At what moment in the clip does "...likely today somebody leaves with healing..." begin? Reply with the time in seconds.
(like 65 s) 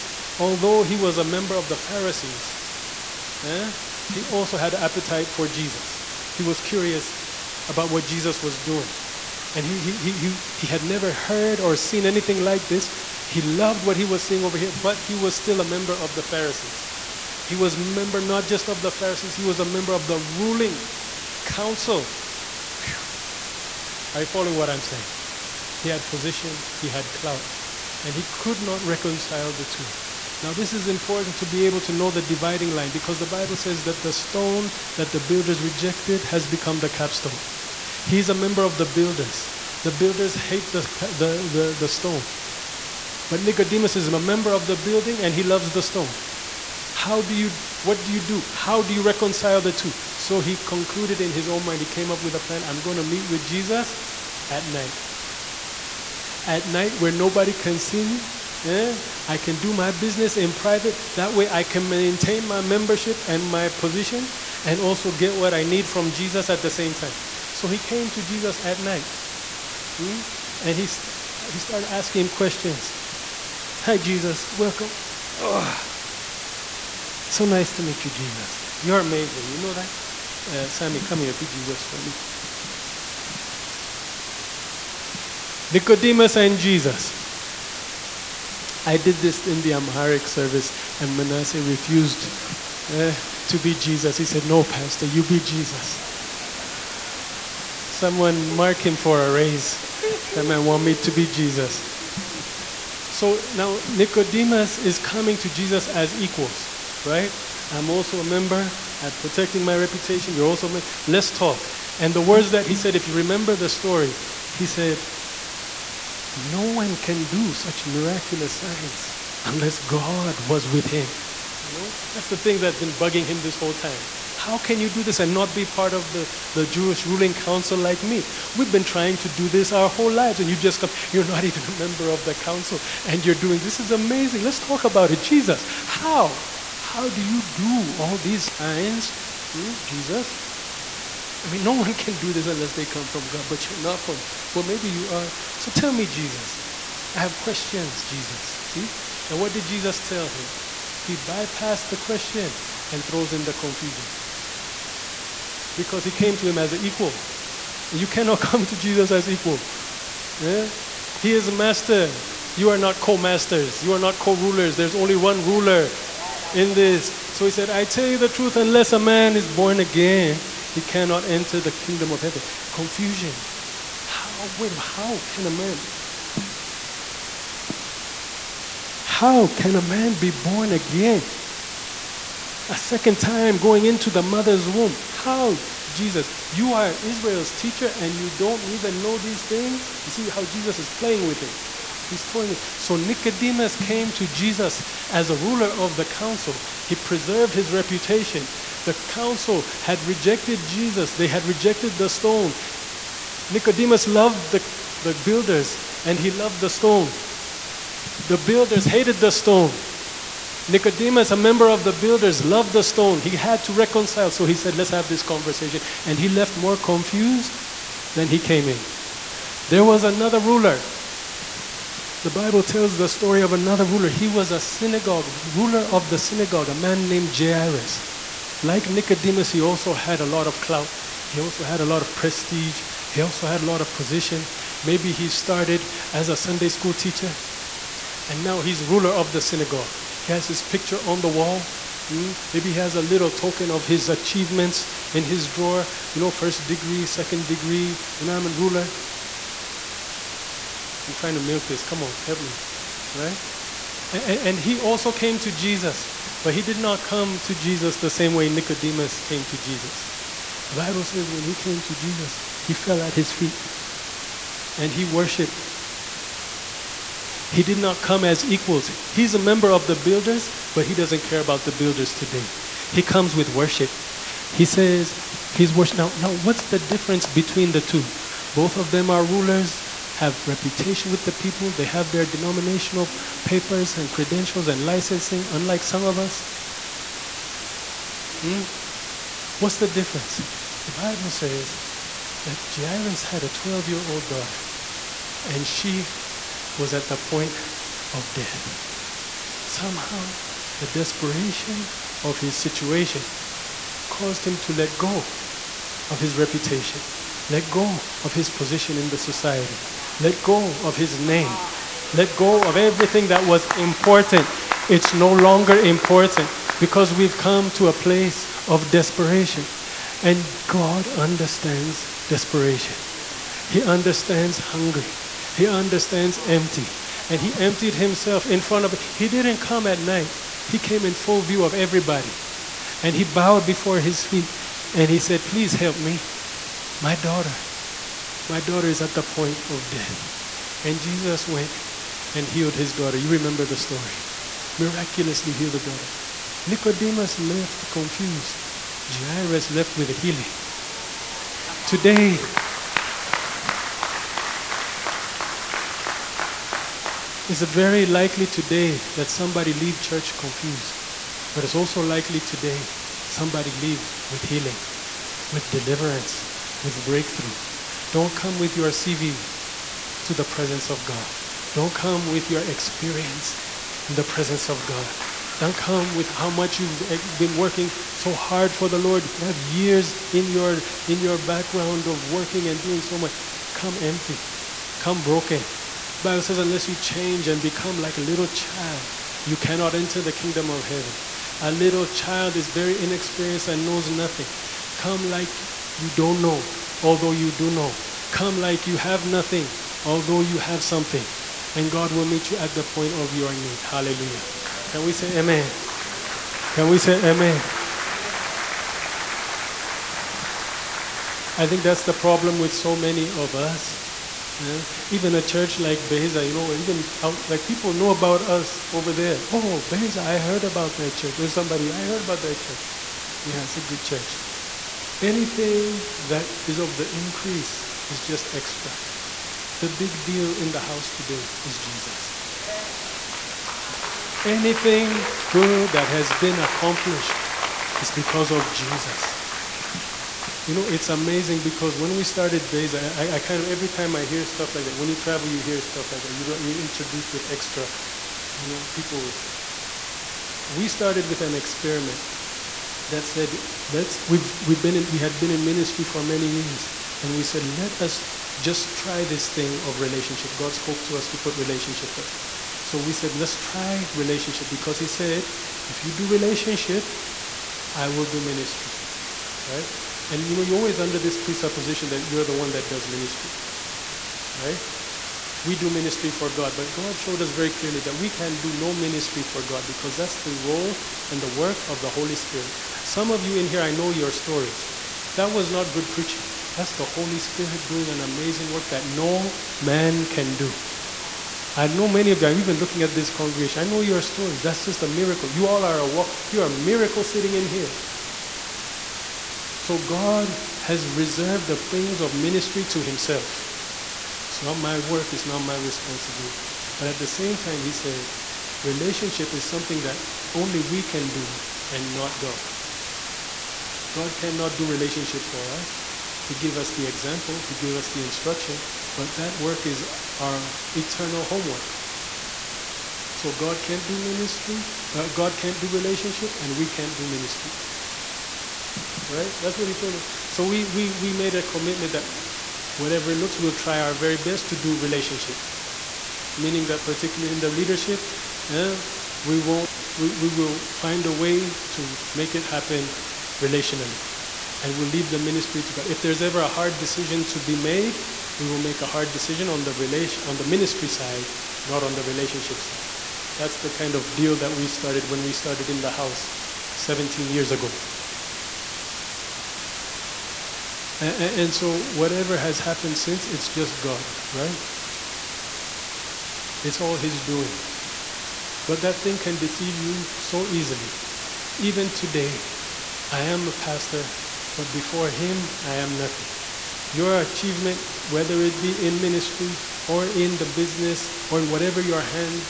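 362 s.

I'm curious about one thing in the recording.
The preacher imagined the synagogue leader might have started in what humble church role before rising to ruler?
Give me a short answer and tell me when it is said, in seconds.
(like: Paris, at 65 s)
Sunday school teacher, at 236 s.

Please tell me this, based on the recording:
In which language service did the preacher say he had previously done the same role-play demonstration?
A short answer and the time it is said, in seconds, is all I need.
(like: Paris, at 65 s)
Amharic, at 89 s.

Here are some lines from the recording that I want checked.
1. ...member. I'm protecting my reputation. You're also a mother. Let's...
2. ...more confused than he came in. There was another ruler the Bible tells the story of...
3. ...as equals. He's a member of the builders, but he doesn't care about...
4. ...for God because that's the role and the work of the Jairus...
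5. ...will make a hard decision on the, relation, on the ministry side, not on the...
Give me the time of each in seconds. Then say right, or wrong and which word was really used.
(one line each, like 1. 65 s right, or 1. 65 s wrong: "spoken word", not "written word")
1. 108 s wrong: "member", not "mother"
2. 216 s right
3. 268 s right
4. 479 s wrong: "Holy", not "Jairus"
5. 548 s right.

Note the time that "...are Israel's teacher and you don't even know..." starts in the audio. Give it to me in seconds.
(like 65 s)
186 s.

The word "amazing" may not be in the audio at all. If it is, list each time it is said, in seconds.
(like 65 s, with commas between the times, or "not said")
78 s, 133 s, 441 s, 488 s.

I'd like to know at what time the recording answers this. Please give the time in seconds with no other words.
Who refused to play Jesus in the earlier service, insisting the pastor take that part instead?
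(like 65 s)
91 s.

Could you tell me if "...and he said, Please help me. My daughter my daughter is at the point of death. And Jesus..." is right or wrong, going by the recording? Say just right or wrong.
right.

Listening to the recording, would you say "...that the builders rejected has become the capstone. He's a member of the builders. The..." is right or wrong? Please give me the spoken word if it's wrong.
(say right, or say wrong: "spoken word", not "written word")
right.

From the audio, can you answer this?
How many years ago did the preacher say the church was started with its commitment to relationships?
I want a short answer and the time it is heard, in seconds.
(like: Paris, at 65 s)
17, at 556 s.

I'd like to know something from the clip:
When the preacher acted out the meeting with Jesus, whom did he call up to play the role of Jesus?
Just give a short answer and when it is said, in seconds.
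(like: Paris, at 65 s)
Sammy, at 80 s.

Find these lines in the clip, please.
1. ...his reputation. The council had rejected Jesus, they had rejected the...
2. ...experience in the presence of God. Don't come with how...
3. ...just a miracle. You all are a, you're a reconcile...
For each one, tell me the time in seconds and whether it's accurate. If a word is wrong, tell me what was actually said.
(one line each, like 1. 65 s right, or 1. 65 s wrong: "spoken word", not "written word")
1. 197 s right
2. 372 s right
3. 494 s wrong: "miracle", not "reconcile".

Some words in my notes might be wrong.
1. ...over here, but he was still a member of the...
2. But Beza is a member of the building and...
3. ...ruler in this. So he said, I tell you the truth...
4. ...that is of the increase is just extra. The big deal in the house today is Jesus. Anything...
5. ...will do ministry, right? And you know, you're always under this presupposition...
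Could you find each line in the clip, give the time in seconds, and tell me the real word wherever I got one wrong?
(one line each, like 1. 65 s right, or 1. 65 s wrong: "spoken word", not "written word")
1. 14 s right
2. 43 s wrong: "Nicodemus", not "Beza"
3. 165 s right
4. 426 s right
5. 468 s right.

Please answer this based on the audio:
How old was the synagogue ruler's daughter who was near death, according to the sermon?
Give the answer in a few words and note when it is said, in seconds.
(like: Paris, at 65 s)
12, at 293 s.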